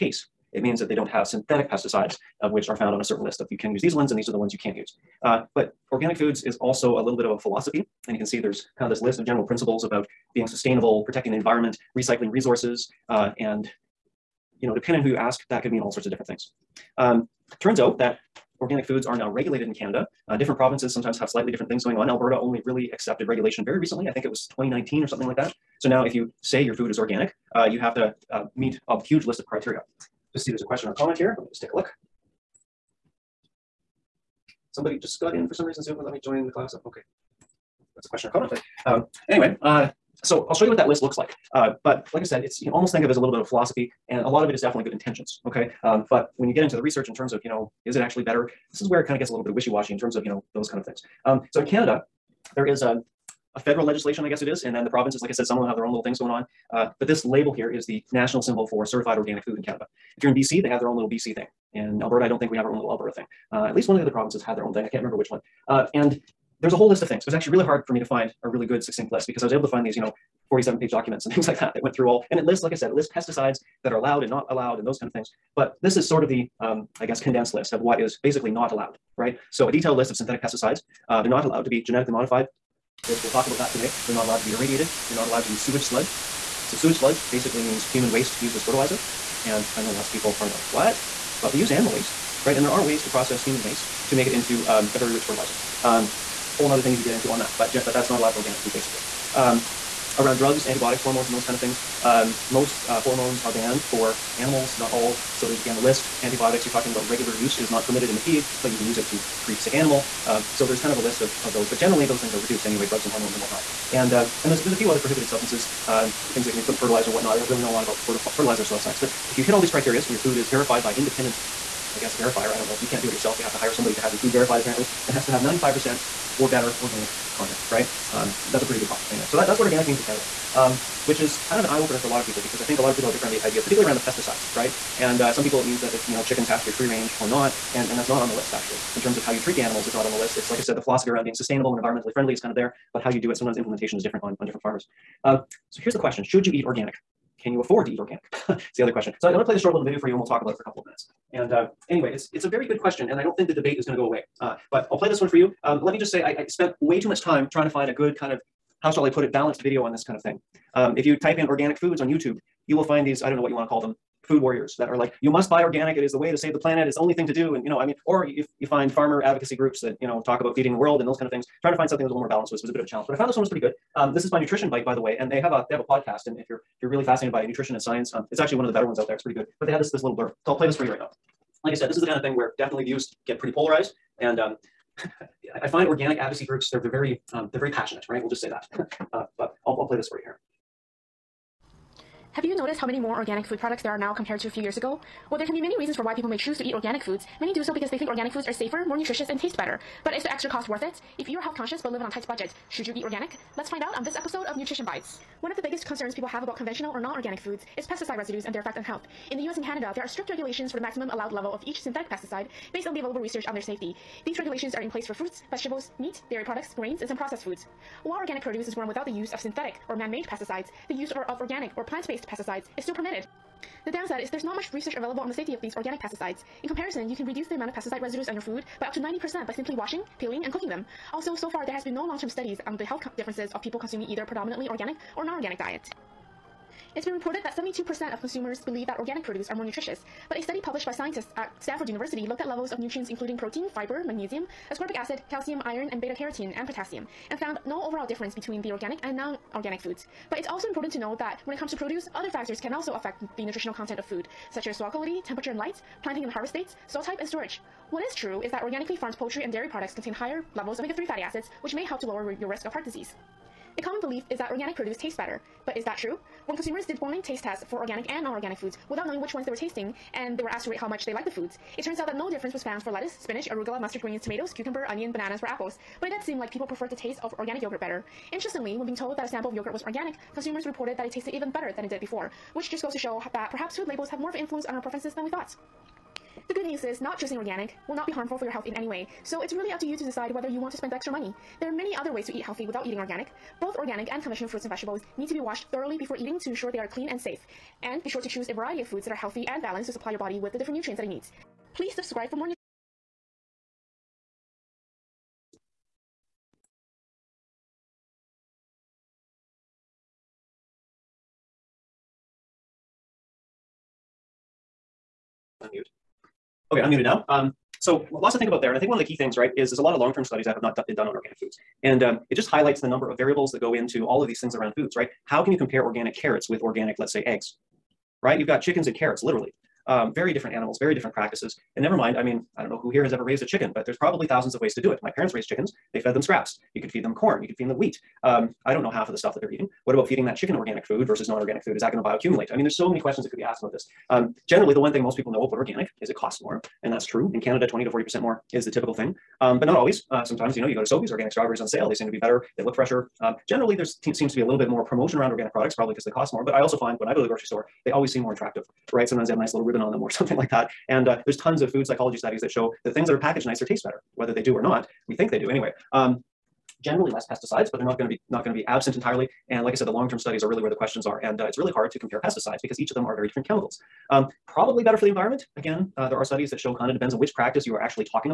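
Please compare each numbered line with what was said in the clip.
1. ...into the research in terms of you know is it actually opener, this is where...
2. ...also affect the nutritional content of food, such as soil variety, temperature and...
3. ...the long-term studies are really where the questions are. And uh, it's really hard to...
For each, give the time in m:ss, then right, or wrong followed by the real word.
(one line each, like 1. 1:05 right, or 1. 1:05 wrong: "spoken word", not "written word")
1. 0:46 wrong: "better", not "opener"
2. 4:12 wrong: "quality", not "variety"
3. 6:09 right.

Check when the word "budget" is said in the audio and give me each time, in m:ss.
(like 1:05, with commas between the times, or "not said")
3:22.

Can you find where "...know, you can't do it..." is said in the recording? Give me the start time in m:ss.
2:02.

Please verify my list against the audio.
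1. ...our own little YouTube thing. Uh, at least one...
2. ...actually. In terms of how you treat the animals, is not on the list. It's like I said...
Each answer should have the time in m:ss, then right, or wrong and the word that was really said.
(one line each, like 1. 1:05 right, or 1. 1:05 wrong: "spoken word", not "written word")
1. 1:02 wrong: "Alberta", not "YouTube"
2. 2:18 right.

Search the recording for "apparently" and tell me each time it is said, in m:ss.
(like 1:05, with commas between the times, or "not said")
2:04.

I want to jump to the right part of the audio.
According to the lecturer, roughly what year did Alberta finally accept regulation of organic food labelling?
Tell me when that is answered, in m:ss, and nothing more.
0:24.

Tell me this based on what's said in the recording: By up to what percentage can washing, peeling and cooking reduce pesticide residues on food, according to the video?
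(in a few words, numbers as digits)
90%.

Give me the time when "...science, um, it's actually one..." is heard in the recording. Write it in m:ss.
2:57.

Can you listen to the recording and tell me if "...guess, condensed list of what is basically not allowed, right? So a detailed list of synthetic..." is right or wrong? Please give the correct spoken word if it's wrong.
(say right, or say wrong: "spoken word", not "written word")
right.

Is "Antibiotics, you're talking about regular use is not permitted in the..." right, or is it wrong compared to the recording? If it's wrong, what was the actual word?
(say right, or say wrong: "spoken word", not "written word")
right.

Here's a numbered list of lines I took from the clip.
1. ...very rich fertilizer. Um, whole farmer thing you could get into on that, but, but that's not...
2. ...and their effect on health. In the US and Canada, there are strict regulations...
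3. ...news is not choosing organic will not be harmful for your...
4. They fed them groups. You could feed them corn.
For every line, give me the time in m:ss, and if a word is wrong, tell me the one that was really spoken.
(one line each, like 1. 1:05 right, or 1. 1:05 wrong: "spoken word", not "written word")
1. 1:34 wrong: "nother", not "farmer"
2. 3:28 right
3. 4:46 right
4. 5:35 wrong: "scraps", not "groups".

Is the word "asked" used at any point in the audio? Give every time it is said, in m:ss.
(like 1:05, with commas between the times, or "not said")
4:30, 5:43.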